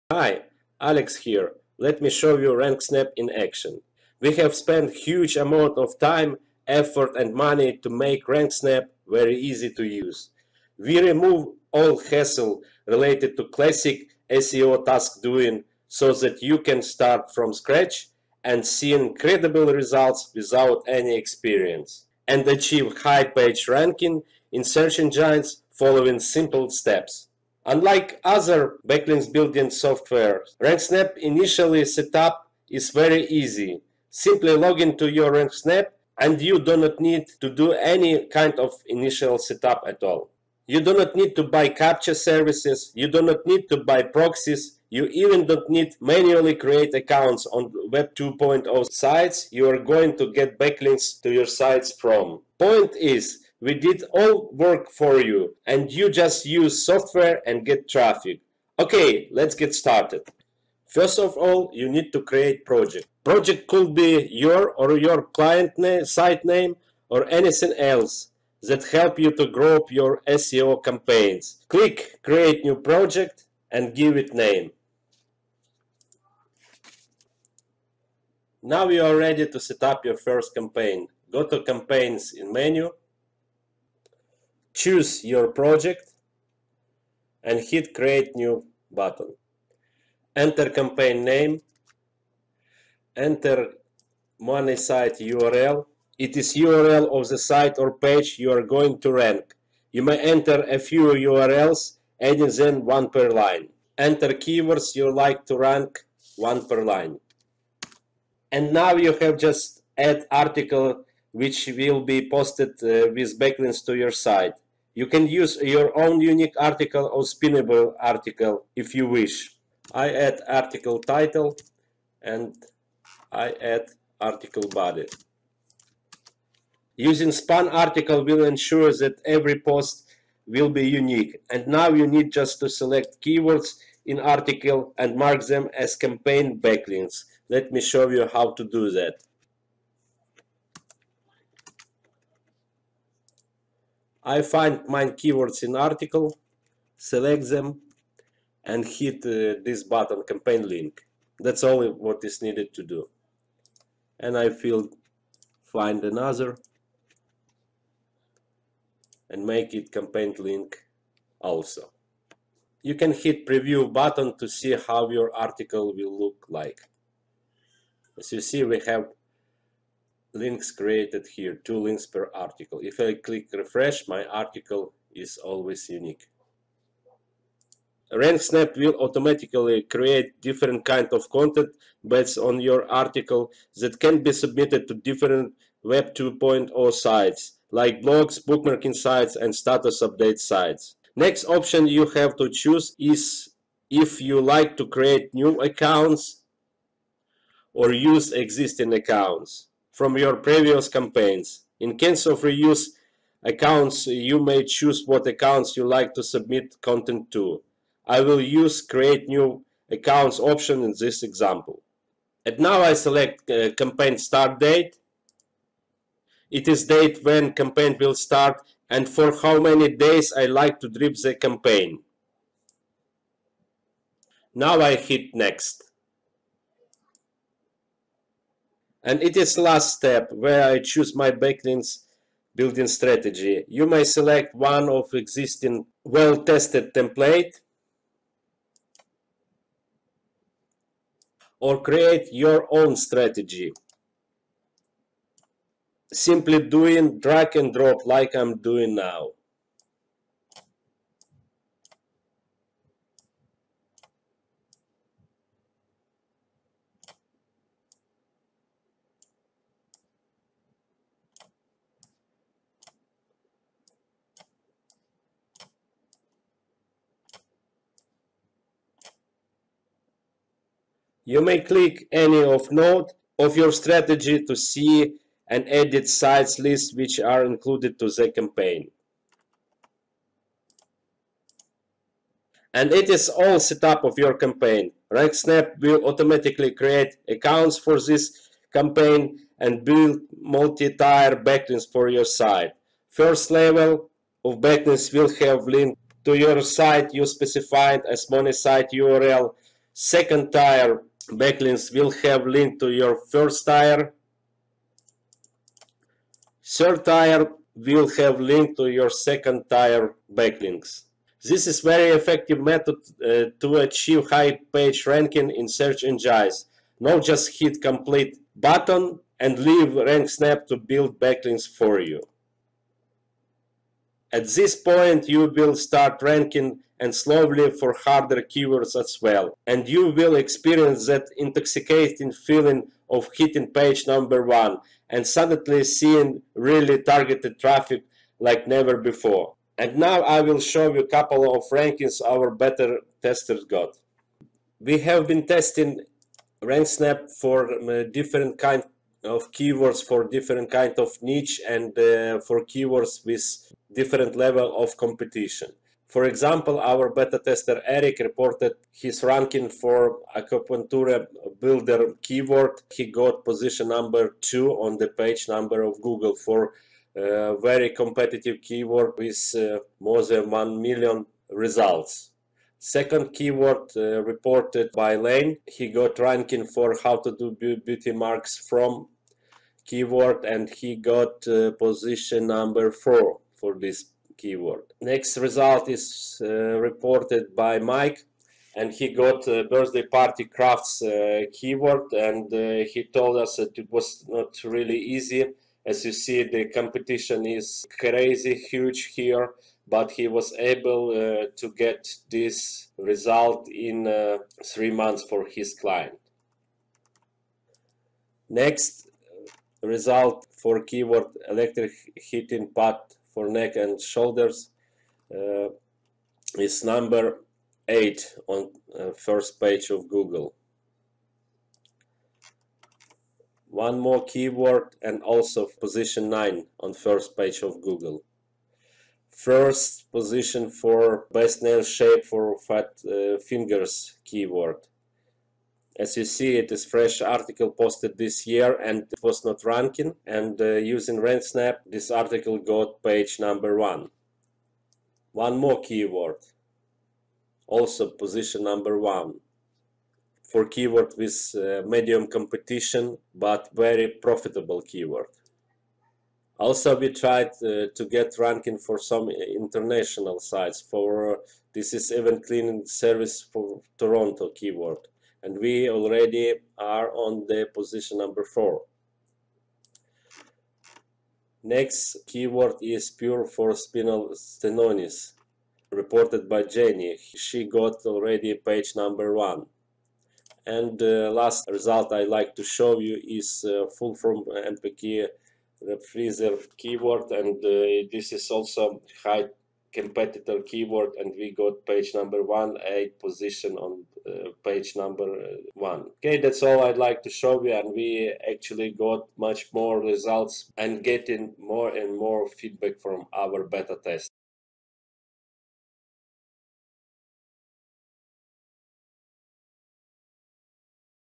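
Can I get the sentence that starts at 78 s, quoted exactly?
Now you are ready to set up your first campaign.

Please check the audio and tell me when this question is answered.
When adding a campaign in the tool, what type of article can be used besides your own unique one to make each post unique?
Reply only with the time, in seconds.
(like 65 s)
117 s.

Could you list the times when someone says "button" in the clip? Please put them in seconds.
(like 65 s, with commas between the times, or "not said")
88 s, 149 s, 163 s, 318 s.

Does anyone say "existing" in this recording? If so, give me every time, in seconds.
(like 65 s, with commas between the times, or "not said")
198 s, 235 s.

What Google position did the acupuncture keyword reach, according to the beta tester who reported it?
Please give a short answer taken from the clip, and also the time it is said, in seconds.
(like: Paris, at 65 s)
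2, at 363 s.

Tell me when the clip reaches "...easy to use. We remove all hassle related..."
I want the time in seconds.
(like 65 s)
9 s.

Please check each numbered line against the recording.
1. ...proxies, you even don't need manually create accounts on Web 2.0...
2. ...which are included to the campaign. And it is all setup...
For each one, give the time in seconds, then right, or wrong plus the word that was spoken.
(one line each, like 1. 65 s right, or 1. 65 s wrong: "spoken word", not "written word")
1. 44 s right
2. 276 s right.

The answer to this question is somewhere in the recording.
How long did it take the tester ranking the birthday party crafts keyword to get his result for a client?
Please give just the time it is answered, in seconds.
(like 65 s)
404 s.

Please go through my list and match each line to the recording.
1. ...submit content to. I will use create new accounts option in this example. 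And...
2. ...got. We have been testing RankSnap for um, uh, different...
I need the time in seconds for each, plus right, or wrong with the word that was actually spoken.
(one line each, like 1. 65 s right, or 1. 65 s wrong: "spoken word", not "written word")
1. 206 s right
2. 343 s right.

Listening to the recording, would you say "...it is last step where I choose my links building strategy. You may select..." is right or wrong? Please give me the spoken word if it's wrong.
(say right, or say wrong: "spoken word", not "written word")
wrong: "backlinks", not "links".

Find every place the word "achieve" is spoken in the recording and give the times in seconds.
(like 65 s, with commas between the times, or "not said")
22 s, 313 s.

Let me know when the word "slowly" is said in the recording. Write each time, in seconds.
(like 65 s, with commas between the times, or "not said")
327 s.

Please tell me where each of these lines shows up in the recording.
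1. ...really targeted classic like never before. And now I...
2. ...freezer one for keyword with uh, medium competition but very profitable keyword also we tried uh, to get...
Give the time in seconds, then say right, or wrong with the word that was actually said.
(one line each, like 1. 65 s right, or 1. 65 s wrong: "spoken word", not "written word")
1. 336 s wrong: "traffic", not "classic"
2. 448 s wrong: "number", not "freezer".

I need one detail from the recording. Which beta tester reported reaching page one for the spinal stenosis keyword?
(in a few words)
Jenny.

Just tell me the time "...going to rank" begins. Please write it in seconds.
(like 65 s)
98 s.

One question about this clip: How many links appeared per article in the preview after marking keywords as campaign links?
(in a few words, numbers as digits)
2.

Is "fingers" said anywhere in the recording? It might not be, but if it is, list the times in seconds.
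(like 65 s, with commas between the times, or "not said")
433 s.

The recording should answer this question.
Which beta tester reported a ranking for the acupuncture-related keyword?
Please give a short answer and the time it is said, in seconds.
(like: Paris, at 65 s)
Eric, at 357 s.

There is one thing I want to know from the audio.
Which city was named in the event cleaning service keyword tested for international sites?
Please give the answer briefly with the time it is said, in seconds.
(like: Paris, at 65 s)
Toronto, at 463 s.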